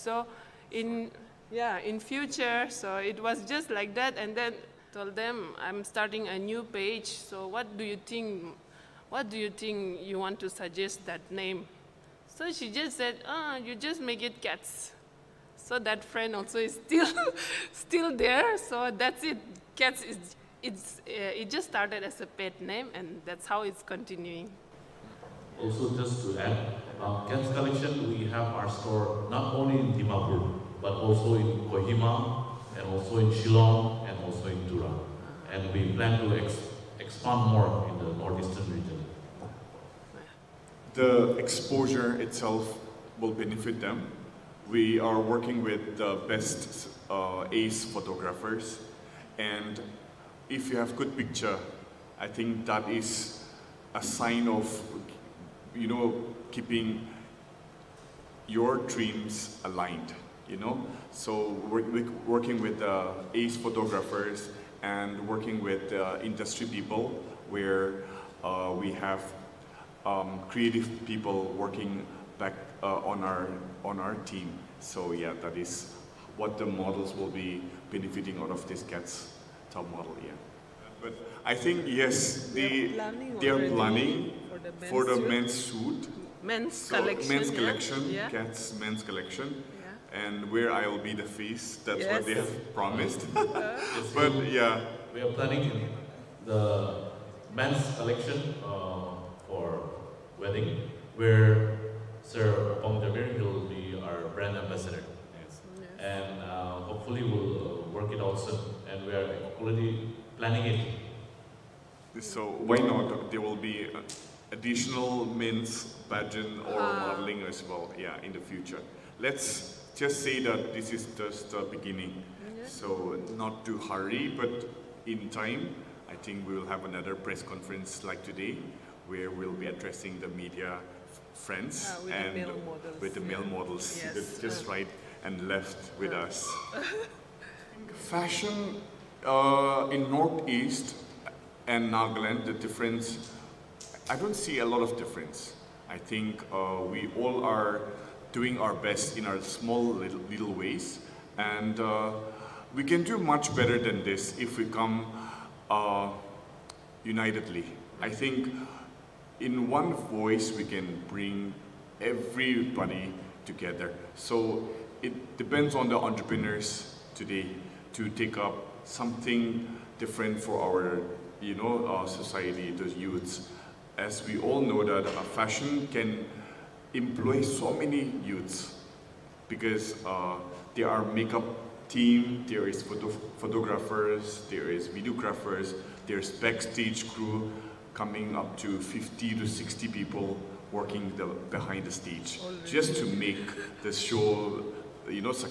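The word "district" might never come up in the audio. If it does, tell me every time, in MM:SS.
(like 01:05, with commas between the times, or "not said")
not said.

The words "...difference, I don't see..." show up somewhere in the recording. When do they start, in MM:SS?
02:22.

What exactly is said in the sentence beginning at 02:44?
So it depends on the entrepreneurs today to take up something different for our, you know, our society, the youths.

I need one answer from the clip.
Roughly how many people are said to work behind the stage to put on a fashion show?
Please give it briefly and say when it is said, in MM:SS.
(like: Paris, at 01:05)
50 to 60, at 03:08.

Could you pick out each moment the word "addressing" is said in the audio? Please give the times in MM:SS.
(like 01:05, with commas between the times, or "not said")
02:09.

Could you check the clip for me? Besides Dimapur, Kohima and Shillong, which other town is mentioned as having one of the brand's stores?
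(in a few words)
Tura.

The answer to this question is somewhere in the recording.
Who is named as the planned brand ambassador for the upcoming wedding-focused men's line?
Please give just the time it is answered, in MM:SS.
01:42.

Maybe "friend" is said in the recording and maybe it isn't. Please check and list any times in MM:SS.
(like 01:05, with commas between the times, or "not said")
00:16, 02:11.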